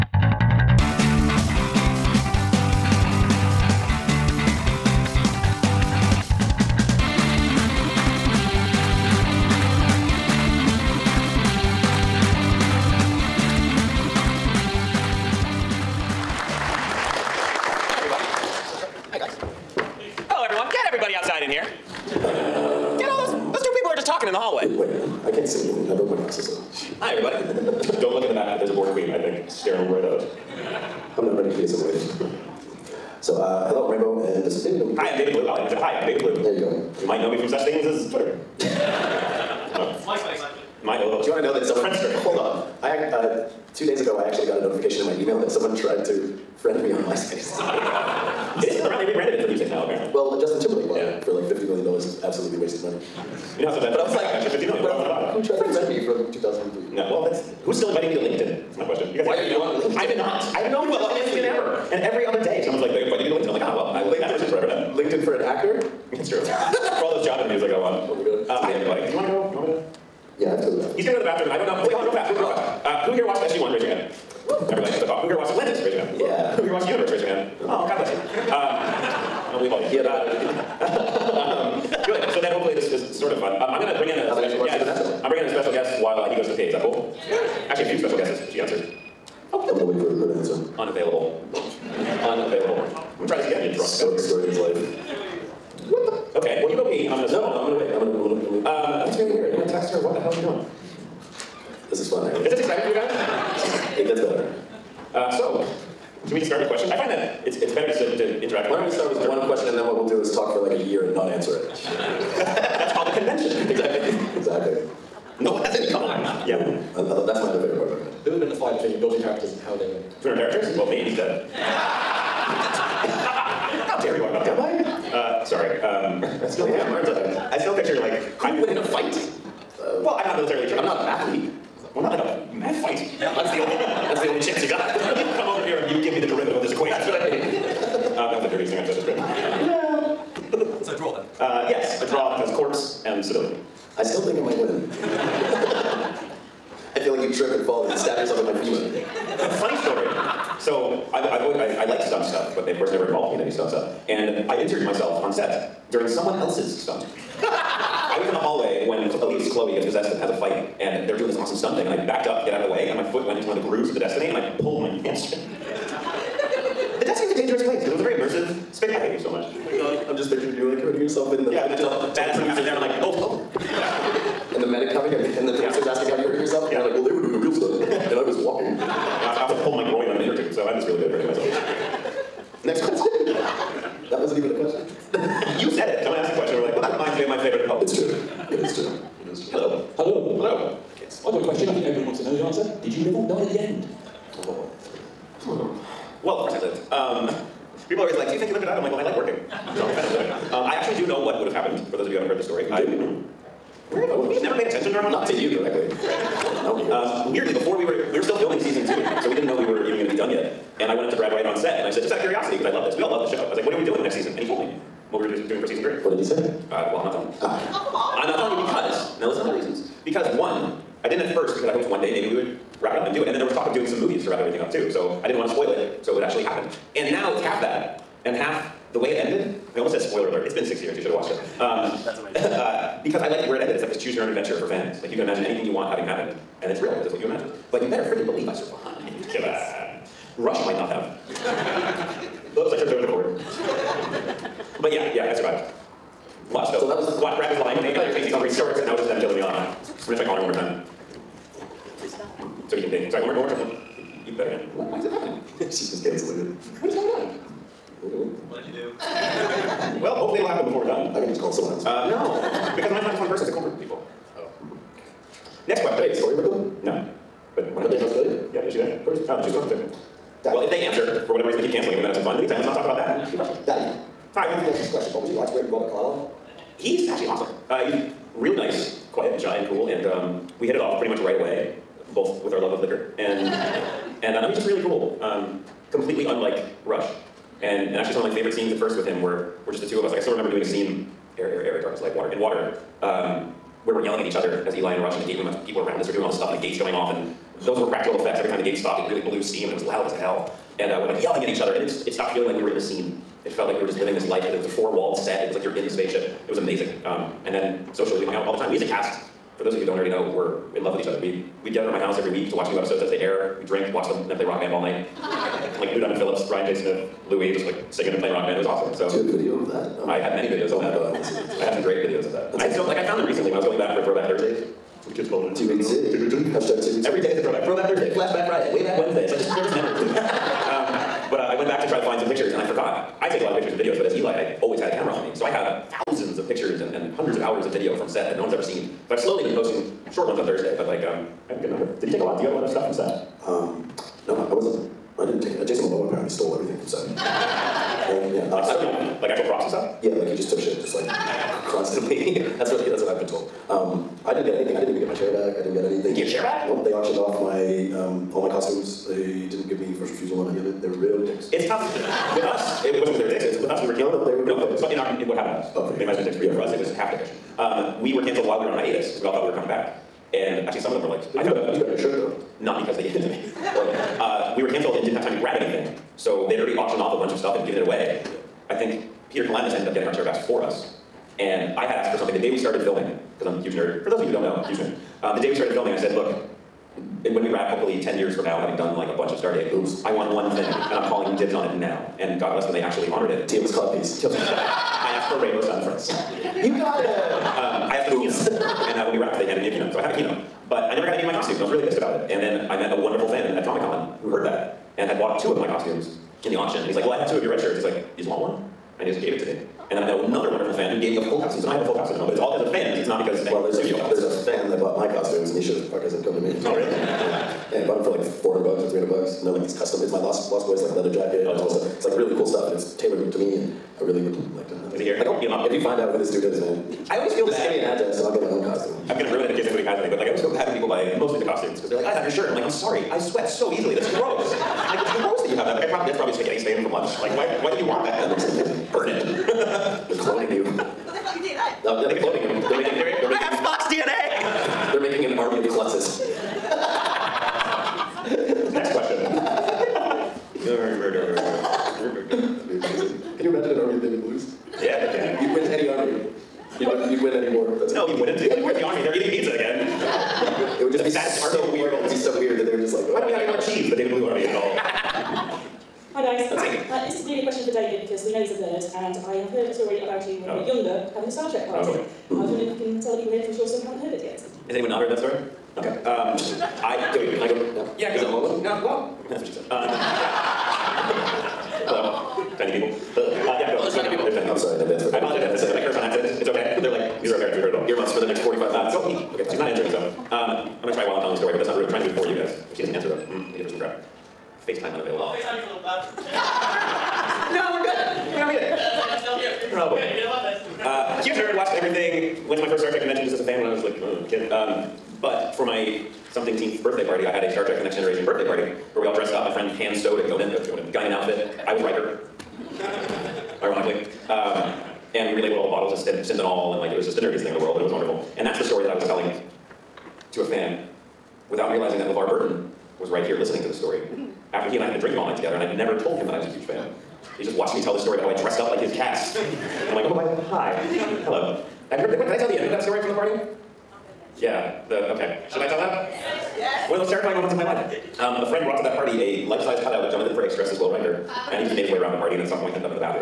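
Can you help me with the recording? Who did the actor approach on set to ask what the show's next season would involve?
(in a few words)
Brad Wright.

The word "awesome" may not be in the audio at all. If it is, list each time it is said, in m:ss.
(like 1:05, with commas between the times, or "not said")
2:41, 4:37, 5:18.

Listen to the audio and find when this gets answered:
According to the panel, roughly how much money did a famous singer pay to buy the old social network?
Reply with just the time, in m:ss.
0:51.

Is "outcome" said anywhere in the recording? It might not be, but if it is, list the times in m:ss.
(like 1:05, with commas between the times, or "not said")
not said.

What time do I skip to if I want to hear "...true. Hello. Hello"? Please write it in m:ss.
3:07.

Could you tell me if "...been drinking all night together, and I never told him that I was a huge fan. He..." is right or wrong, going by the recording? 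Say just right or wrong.
right.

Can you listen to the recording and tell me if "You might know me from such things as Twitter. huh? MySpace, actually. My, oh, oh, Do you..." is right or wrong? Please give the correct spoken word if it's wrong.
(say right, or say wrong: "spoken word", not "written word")
right.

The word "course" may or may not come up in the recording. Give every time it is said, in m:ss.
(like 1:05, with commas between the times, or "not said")
2:32, 3:16.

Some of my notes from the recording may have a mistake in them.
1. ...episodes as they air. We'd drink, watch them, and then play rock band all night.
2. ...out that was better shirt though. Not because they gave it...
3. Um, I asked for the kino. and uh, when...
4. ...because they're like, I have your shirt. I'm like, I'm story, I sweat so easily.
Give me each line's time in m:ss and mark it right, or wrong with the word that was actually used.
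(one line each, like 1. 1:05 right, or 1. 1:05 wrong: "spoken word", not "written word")
1. 5:12 right
2. 6:11 right
3. 6:37 right
4. 7:11 wrong: "sorry", not "story".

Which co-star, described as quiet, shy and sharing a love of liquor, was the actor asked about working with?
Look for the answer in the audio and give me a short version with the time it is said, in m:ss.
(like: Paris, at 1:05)
Robert Carlyle, at 4:35.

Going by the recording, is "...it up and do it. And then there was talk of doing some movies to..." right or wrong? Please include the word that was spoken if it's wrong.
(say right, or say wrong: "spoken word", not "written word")
right.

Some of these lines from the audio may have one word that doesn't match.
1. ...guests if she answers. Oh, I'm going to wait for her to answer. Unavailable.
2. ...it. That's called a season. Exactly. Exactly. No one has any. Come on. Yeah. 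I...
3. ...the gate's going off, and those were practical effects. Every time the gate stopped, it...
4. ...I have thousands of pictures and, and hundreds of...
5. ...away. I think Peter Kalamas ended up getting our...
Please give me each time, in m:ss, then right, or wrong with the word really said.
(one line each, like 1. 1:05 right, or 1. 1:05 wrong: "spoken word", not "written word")
1. 1:28 right
2. 1:51 wrong: "convention", not "season"
3. 4:56 right
4. 5:35 right
5. 6:17 right.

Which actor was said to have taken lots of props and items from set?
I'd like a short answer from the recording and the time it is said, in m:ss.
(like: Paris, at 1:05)
Jason Momoa, at 5:45.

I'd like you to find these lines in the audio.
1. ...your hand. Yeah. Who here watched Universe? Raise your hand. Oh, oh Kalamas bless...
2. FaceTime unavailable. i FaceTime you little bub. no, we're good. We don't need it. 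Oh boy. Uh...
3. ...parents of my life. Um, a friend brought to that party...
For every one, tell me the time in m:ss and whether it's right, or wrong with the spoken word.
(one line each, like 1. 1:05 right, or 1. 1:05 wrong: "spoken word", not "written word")
1. 1:15 wrong: "God", not "Kalamas"
2. 8:14 right
3. 8:57 wrong: "moments", not "parents".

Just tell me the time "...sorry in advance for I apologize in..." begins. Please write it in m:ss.
8:04.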